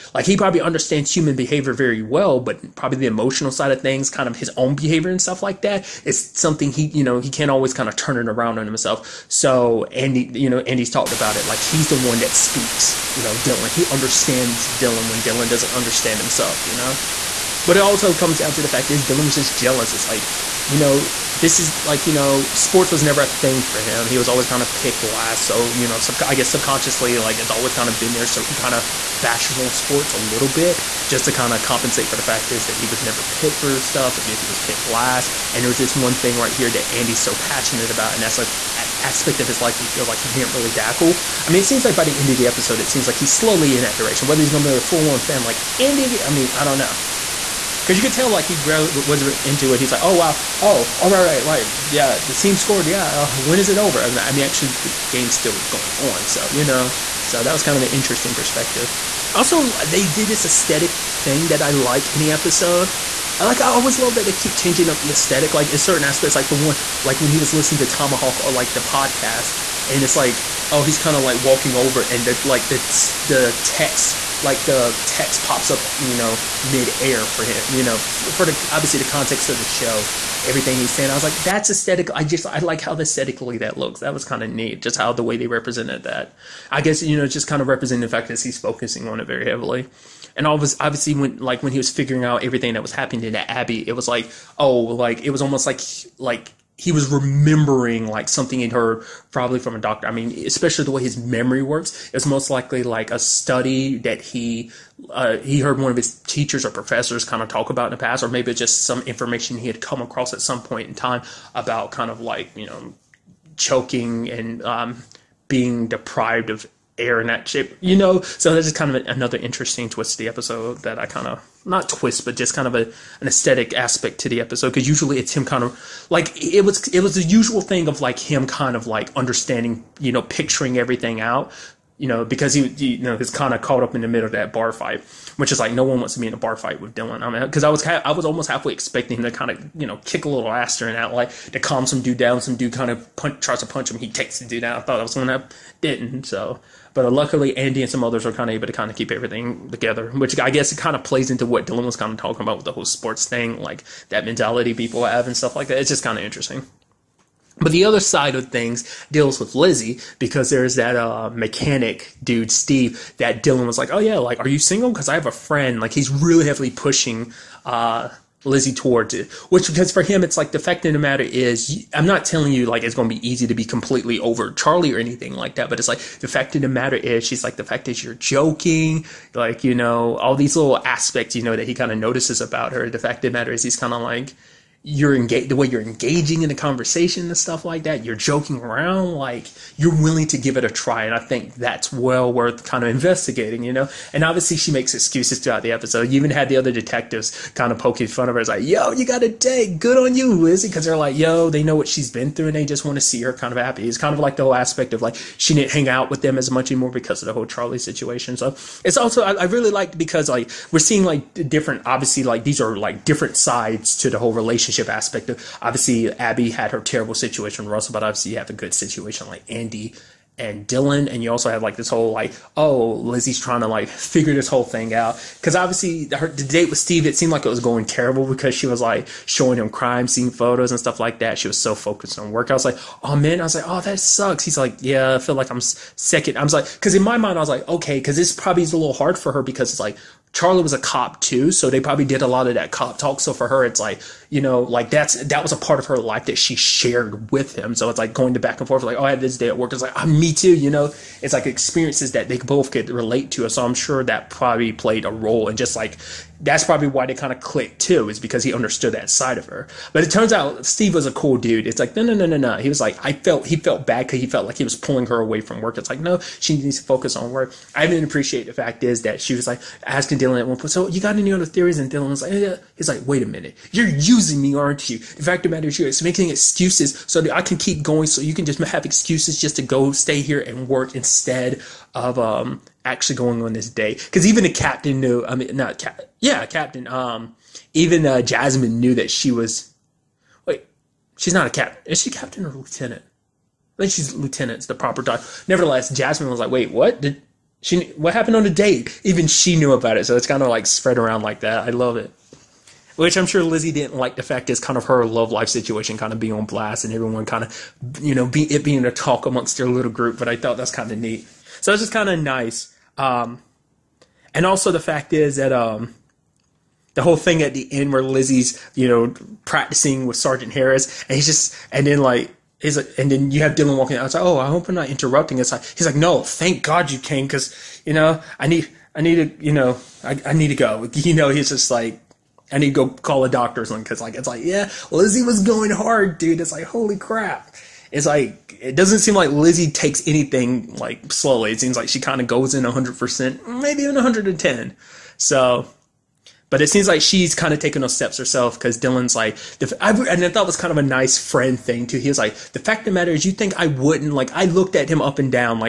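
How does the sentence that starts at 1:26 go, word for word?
I guess, you know, just kind of representing the fact that he's focusing on it very heavily.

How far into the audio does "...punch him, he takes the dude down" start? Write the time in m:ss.
2:23.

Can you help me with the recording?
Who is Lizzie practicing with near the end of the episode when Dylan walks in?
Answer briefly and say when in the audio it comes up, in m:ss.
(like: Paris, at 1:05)
Sergeant Harris, at 5:20.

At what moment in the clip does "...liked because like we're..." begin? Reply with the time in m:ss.
3:29.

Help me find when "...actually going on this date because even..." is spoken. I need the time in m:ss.
4:42.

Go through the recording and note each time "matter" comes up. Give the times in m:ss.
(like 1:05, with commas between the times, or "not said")
2:50, 2:56, 3:03, 4:35, 5:52.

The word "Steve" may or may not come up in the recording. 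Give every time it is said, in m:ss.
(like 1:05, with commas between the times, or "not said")
2:42, 3:46, 4:20.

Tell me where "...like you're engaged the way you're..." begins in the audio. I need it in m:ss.
3:03.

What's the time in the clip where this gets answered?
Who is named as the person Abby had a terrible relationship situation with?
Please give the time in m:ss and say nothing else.
3:37.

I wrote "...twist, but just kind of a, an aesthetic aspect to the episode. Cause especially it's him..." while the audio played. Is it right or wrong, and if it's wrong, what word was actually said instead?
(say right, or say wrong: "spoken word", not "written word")
wrong: "usually", not "especially".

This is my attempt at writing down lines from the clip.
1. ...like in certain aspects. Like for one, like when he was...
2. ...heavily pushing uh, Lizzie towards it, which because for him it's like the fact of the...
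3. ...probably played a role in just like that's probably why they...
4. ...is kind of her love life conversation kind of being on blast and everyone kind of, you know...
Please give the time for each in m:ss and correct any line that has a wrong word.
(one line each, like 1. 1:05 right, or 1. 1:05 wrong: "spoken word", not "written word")
1. 1:05 right
2. 2:46 right
3. 4:14 right
4. 5:04 wrong: "situation", not "conversation".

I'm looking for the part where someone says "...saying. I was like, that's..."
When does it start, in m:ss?
1:20.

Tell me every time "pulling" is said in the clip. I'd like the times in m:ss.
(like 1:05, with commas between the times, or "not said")
4:24.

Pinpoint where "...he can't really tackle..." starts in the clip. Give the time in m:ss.
0:40.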